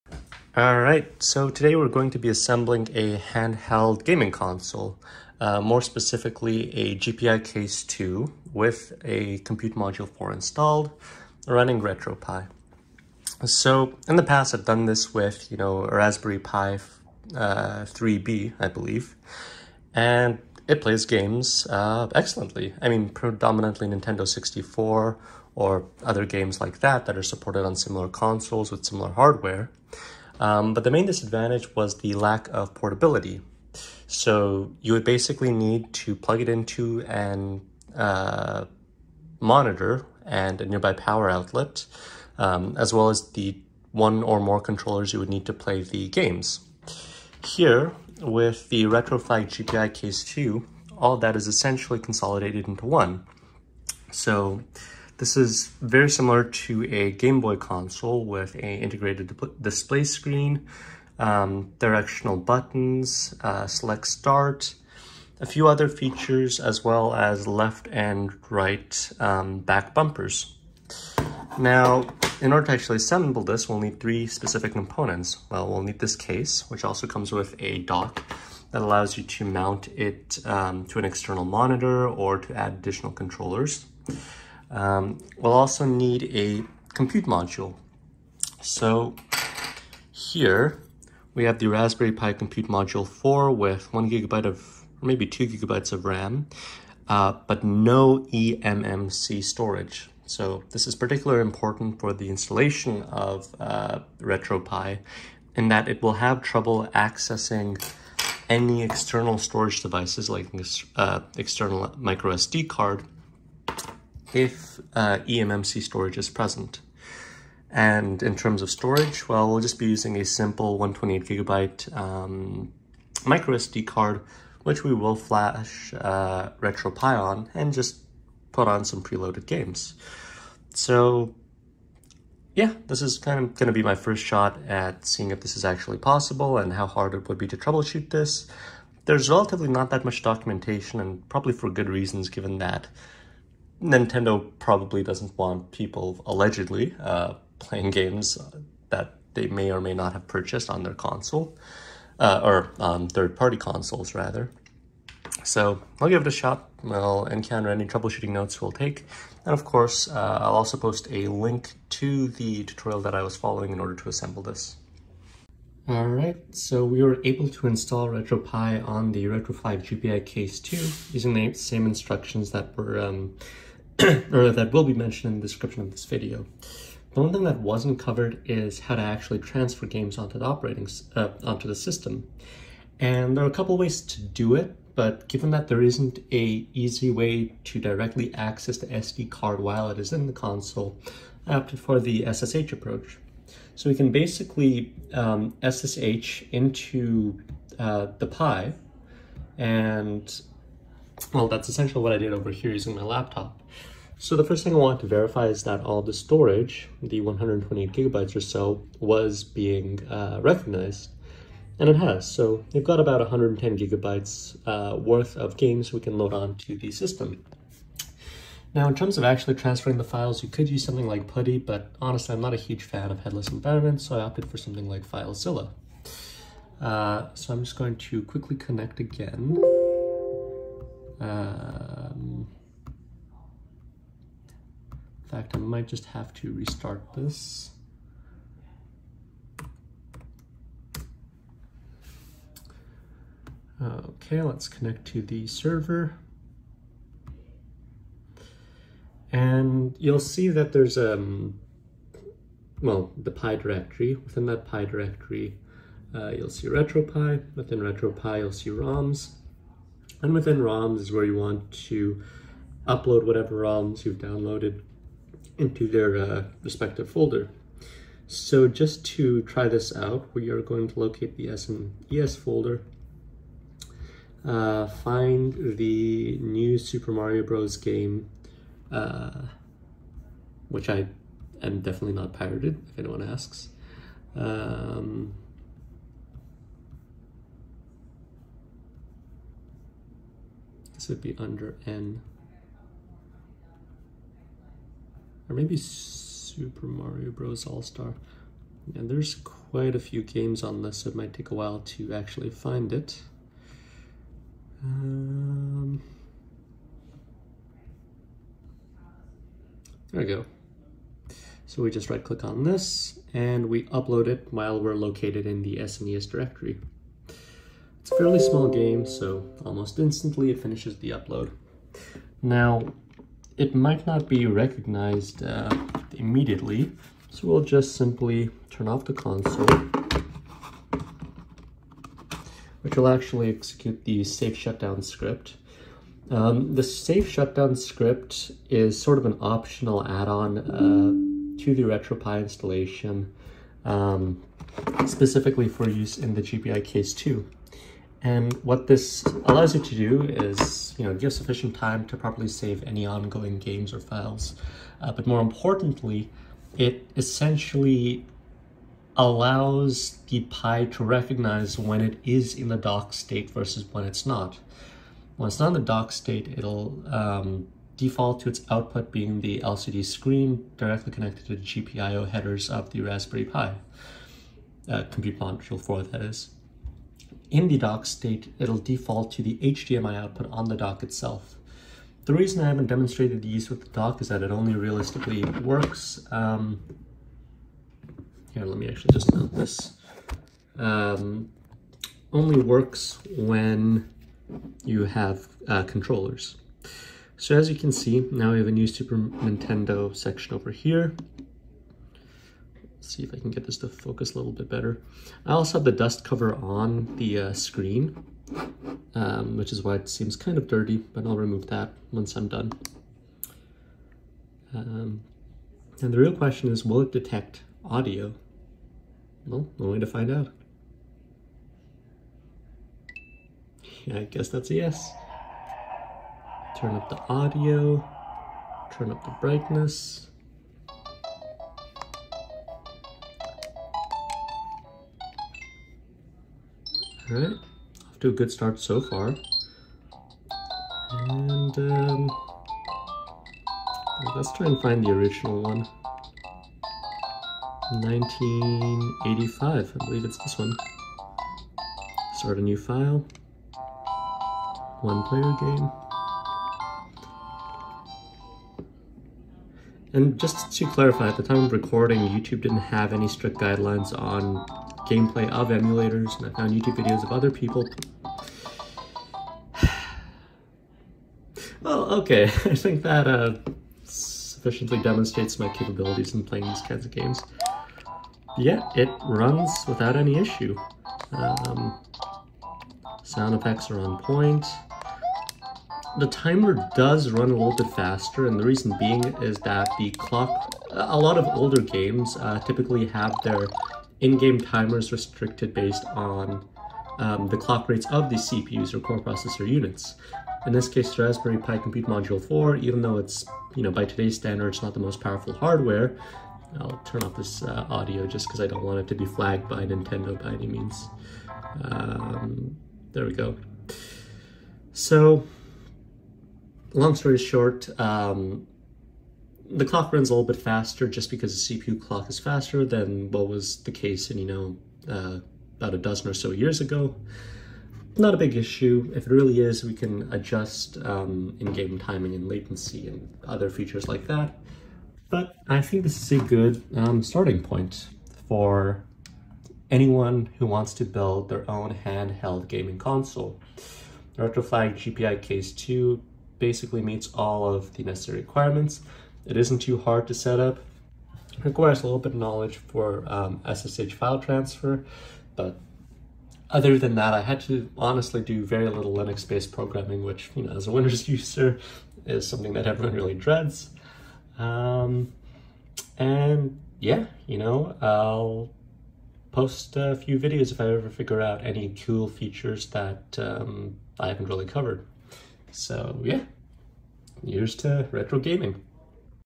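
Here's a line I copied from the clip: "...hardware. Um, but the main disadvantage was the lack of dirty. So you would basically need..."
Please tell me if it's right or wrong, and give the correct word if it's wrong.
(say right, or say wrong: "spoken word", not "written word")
wrong: "portability", not "dirty".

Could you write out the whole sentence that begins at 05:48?
And what this allows you to do is, you know, give sufficient time to properly save any ongoing games or files.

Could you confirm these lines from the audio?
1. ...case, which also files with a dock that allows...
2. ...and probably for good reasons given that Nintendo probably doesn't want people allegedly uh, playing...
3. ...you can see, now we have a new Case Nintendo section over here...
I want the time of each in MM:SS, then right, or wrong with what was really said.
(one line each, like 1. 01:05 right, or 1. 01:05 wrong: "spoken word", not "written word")
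1. 01:16 wrong: "comes", not "files"
2. 02:20 right
3. 06:37 wrong: "Super", not "Case".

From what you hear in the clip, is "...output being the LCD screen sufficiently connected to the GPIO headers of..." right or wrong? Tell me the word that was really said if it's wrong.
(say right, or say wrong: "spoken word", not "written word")
wrong: "directly", not "sufficiently".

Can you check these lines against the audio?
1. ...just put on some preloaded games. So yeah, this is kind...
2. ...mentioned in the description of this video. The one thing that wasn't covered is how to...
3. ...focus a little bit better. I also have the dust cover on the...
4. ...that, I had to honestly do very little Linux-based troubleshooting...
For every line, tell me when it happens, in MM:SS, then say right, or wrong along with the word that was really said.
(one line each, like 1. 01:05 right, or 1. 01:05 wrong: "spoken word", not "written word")
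1. 02:07 right
2. 02:54 right
3. 06:43 right
4. 09:17 wrong: "programming", not "troubleshooting".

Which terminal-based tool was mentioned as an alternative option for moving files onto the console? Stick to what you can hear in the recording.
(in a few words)
PuTTY.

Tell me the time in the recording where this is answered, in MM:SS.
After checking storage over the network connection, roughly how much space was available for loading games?
03:33.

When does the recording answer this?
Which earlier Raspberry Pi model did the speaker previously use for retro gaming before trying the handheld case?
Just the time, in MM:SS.
00:15.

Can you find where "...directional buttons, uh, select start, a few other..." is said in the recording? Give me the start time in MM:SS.
01:01.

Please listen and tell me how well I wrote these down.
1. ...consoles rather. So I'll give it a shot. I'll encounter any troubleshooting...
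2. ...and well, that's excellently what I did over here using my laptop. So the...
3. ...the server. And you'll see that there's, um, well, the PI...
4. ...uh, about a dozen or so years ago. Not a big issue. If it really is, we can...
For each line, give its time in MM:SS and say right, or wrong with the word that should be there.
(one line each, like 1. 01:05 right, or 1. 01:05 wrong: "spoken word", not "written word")
1. 02:33 right
2. 03:19 wrong: "essentially", not "excellently"
3. 04:05 right
4. 08:45 right.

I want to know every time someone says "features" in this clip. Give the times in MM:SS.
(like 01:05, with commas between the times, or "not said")
01:05, 08:53, 09:32.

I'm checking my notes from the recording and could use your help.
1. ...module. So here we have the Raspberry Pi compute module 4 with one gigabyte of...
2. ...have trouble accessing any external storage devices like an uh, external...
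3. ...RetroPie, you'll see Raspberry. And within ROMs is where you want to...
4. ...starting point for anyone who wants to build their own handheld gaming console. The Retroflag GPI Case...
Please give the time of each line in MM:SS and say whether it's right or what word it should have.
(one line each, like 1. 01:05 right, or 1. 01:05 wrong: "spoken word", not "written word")
1. 01:27 right
2. 01:46 right
3. 04:17 wrong: "ROMs", not "Raspberry"
4. 08:57 right.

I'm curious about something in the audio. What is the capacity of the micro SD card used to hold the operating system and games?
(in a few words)
128 gigabytes.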